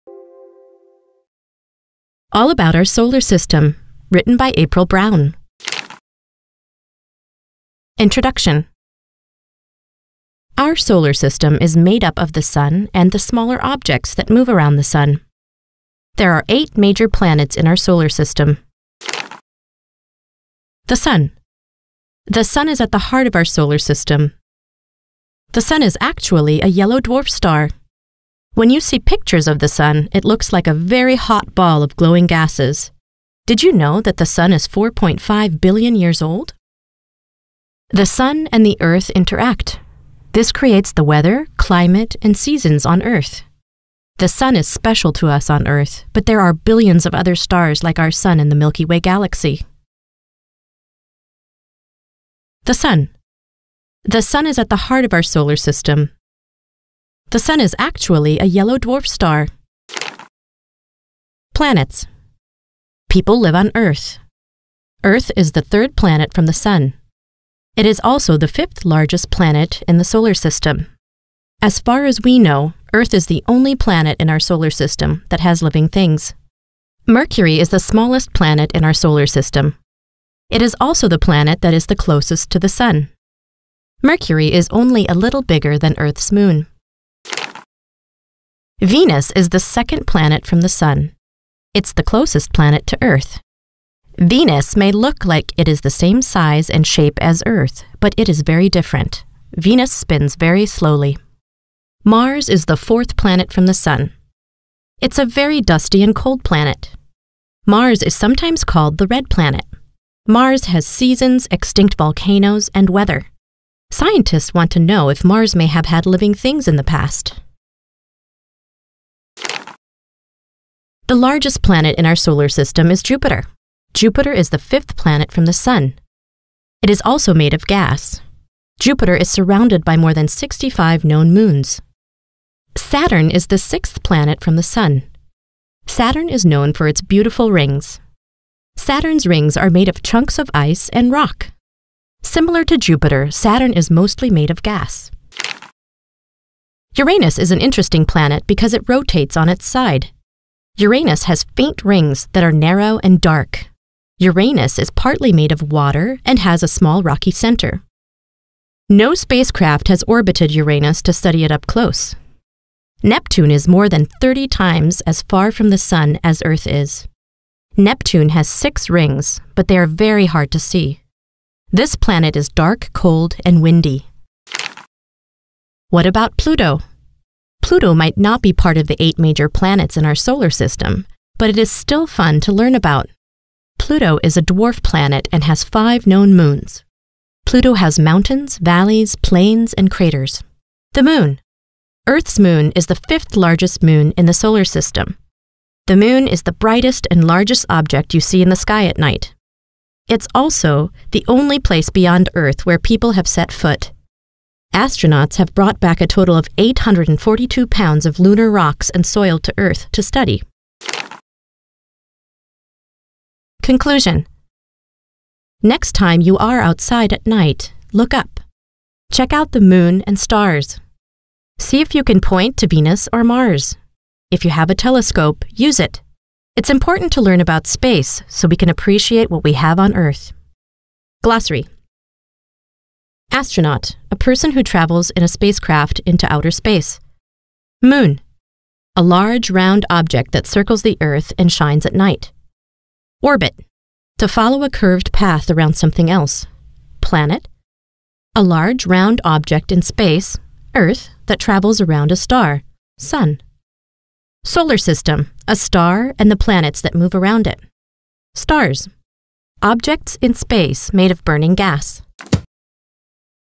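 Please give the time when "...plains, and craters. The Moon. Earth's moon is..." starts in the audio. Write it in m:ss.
3:09.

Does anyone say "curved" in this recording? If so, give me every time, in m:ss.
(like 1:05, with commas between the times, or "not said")
4:04.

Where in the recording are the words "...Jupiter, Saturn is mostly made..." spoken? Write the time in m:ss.
2:22.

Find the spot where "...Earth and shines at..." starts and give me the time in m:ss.
4:01.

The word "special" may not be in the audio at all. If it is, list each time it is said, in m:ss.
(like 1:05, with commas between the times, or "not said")
0:44.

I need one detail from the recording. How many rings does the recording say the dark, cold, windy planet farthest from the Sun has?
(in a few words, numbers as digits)
6.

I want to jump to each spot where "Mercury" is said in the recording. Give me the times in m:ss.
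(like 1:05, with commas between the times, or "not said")
1:17, 1:24.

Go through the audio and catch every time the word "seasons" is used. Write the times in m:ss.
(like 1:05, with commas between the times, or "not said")
0:42, 1:50.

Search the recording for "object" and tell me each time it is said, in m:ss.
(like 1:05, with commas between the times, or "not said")
0:13, 3:17, 3:59, 4:09, 4:19.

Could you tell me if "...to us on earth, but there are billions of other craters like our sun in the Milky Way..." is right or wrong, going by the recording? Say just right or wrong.
wrong.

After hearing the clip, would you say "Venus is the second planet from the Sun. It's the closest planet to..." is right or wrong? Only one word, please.
right.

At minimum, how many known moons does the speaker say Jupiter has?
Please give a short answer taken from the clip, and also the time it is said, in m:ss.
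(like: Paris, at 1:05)
more than 65, at 2:09.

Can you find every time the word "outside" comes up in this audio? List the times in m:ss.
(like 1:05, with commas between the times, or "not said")
3:36.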